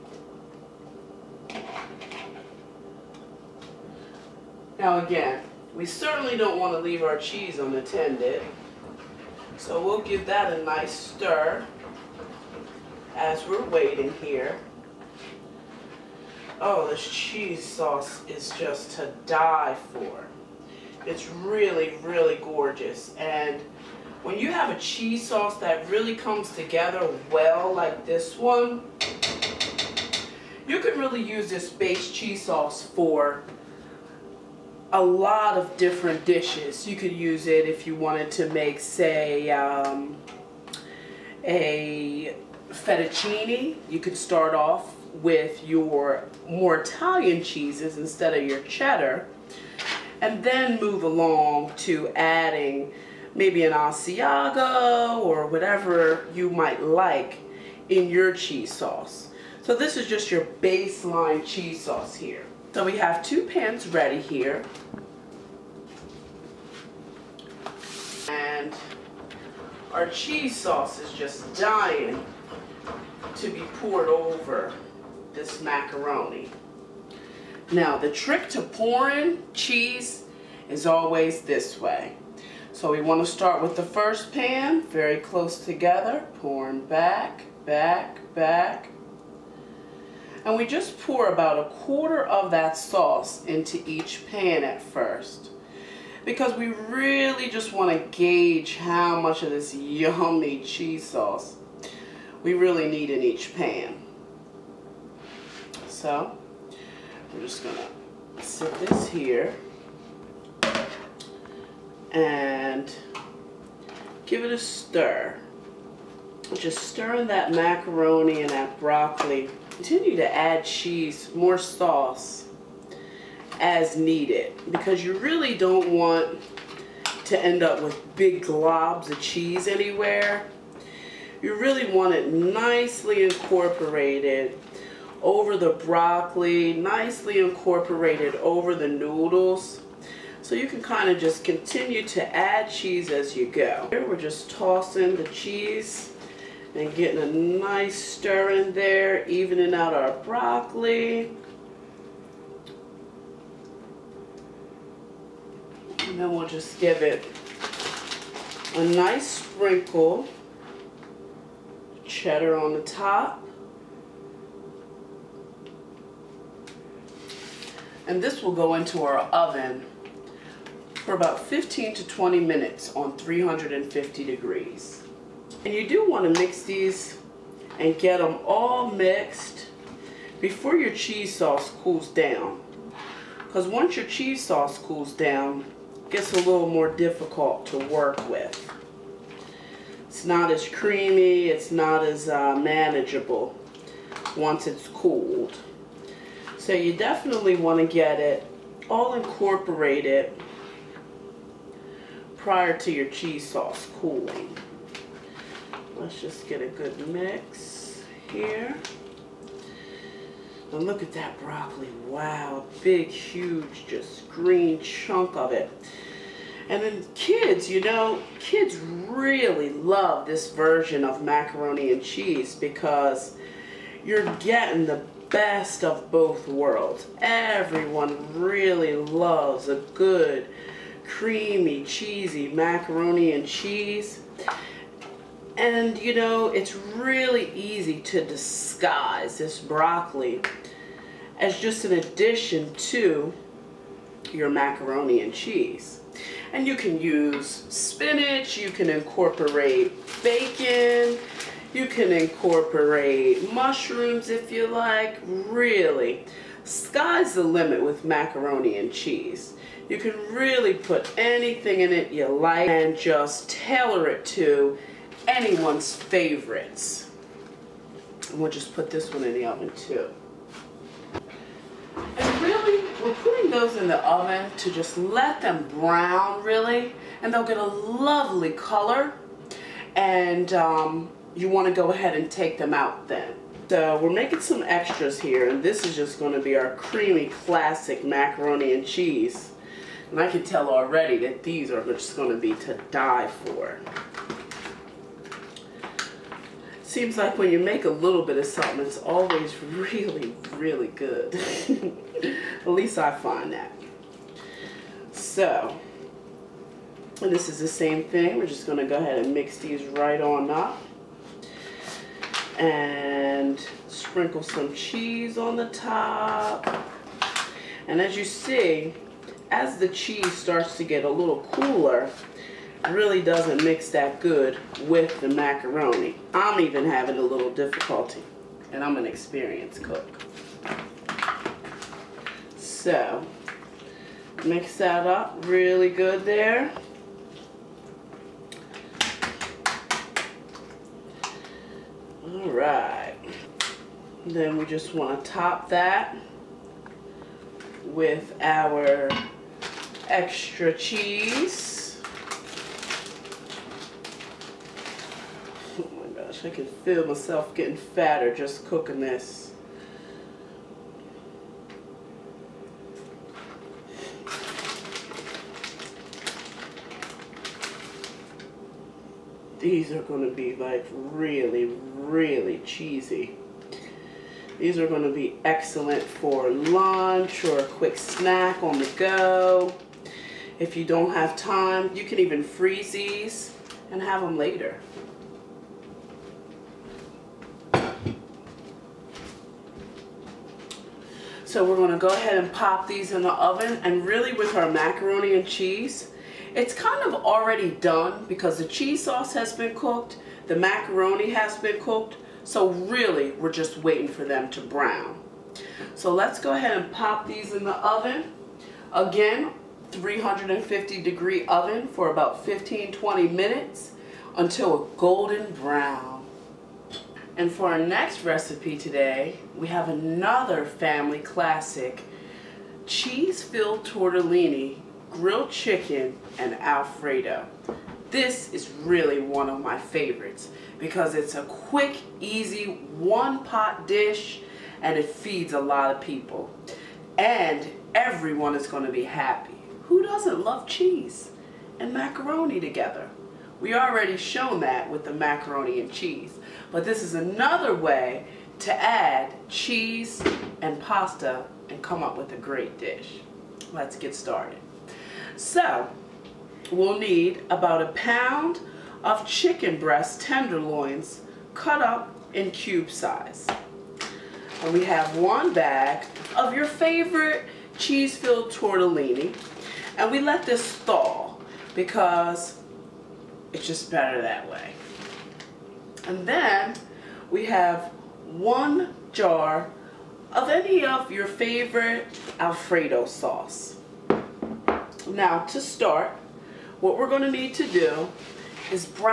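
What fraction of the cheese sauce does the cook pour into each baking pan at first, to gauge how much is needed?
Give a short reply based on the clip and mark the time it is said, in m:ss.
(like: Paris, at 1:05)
a quarter, at 1:31.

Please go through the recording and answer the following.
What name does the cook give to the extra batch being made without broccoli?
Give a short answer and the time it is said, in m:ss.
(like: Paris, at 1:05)
creamy classic macaroni and cheese, at 4:46.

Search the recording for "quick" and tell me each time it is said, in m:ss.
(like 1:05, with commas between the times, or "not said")
6:17, 7:11.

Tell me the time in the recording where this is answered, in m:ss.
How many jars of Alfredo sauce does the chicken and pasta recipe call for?
7:58.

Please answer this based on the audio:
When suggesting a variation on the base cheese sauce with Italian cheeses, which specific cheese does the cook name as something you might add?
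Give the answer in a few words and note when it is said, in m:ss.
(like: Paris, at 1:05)
Asiago, at 0:53.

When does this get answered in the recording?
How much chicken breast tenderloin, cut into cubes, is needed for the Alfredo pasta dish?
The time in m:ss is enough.
7:37.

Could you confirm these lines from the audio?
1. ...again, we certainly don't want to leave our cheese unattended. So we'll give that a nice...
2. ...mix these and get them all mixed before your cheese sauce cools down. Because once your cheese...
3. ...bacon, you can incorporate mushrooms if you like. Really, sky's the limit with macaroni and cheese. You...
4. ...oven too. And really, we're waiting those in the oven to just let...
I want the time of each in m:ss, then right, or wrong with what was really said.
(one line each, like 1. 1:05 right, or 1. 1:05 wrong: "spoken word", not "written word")
1. 0:05 right
2. 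2:56 right
3. 4:10 right
4. 4:29 wrong: "putting", not "waiting".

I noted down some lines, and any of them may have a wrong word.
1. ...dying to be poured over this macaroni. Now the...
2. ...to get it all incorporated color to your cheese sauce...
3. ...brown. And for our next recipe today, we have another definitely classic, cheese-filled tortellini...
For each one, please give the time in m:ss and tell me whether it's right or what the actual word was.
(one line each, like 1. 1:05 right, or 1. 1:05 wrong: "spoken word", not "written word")
1. 1:11 right
2. 3:17 wrong: "prior", not "color"
3. 6:55 wrong: "family", not "definitely".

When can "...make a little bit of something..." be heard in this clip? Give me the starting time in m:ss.
4:57.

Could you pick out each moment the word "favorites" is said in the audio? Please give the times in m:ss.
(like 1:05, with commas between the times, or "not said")
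4:25, 7:09, 7:46, 8:01.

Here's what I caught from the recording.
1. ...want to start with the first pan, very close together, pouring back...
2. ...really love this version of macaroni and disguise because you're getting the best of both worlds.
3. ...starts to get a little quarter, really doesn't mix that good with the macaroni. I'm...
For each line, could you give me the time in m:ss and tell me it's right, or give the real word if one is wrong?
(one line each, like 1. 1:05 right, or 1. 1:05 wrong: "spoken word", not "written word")
1. 1:23 right
2. 3:38 wrong: "cheese", not "disguise"
3. 5:20 wrong: "cooler", not "quarter".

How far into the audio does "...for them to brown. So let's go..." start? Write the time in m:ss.
6:44.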